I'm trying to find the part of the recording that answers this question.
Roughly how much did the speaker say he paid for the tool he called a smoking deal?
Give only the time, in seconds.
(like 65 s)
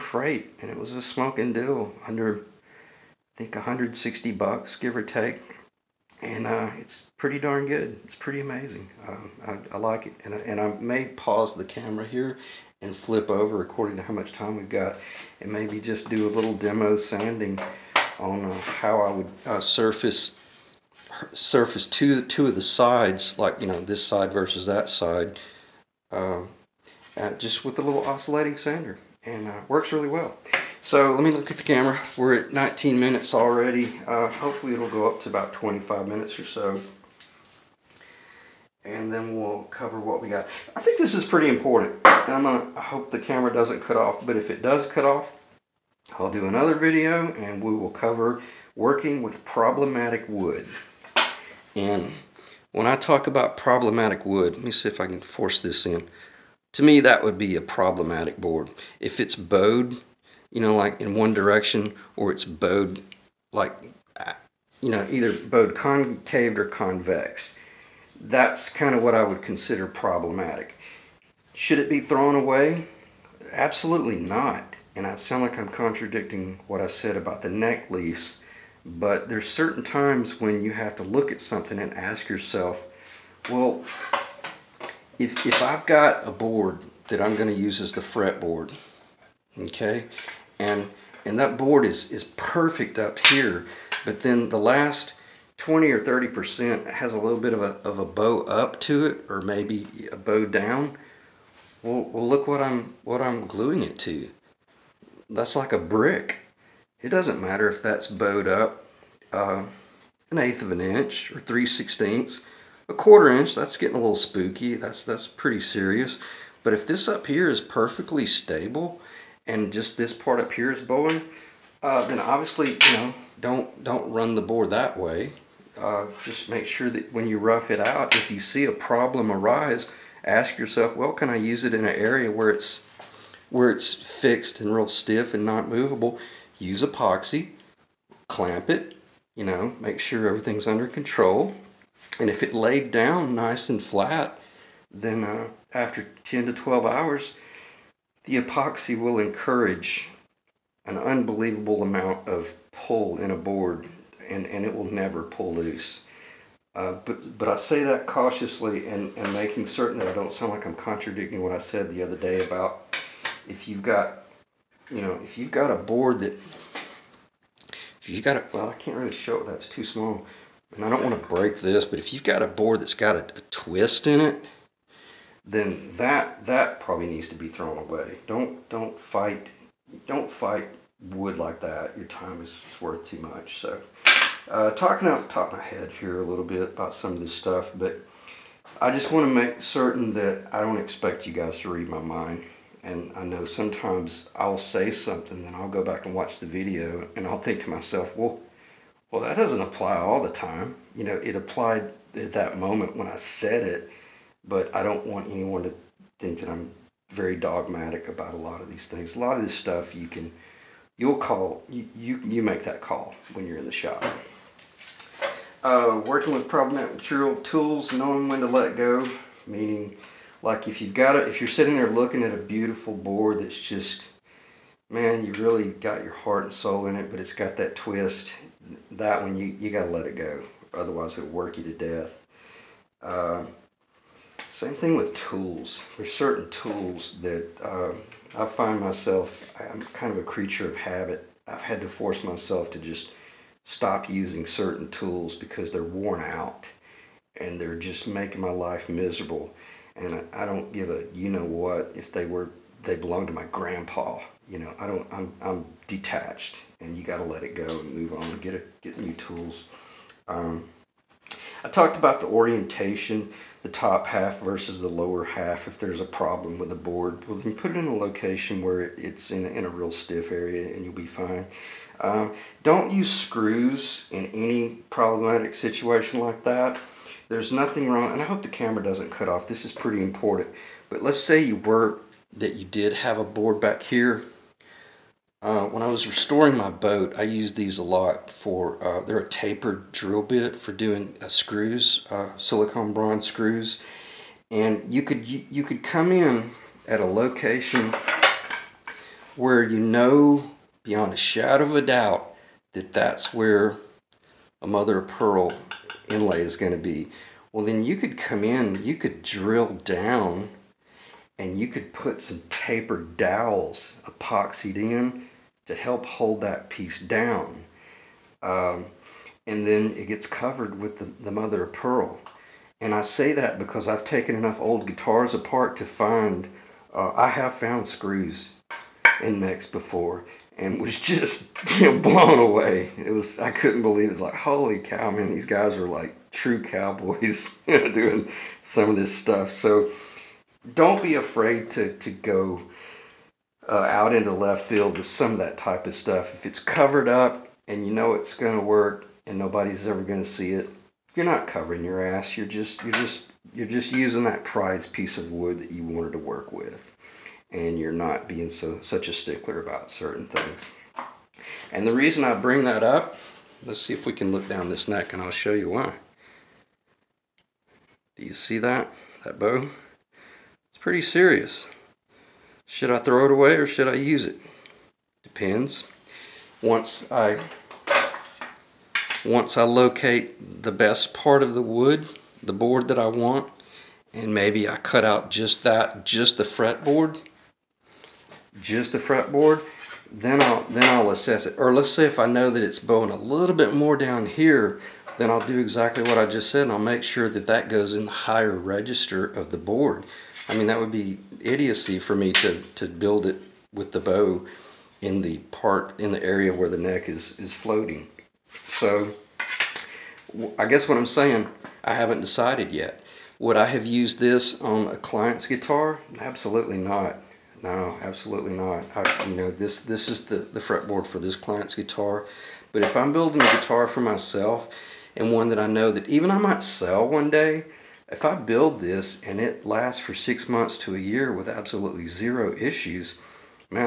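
3 s.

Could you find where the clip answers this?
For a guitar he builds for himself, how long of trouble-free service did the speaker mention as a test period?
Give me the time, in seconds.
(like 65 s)
430 s.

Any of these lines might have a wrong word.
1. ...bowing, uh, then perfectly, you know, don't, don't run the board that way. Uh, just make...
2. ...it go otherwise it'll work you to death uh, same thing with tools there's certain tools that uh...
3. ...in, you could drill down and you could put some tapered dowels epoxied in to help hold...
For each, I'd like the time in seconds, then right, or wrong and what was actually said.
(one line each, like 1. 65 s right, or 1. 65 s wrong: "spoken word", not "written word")
1. 120 s wrong: "obviously", not "perfectly"
2. 230 s right
3. 308 s right.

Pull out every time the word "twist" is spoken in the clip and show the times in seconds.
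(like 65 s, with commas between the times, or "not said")
173 s, 227 s.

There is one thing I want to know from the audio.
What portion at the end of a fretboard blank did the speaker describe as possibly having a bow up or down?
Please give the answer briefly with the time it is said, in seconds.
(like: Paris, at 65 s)
last 20 or 30%, at 94 s.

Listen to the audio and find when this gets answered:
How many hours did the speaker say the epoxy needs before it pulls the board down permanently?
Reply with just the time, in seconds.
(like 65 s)
146 s.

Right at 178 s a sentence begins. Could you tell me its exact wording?
Don't don't fight don't fight wood like that.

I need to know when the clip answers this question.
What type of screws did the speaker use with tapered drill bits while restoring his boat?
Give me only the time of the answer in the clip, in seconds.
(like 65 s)
292 s.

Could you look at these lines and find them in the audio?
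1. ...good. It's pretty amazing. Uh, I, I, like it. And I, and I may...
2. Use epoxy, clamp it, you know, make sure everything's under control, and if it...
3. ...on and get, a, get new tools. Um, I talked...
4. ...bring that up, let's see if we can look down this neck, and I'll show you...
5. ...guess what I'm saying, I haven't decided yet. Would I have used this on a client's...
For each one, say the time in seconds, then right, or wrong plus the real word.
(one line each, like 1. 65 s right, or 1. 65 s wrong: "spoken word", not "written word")
1. 7 s right
2. 136 s right
3. 258 s right
4. 362 s right
5. 410 s right.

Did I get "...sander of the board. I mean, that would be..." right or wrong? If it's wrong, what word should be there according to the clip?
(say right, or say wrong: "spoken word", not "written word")
wrong: "register", not "sander".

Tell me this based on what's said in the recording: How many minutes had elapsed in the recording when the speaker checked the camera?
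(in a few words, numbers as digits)
19 minutes.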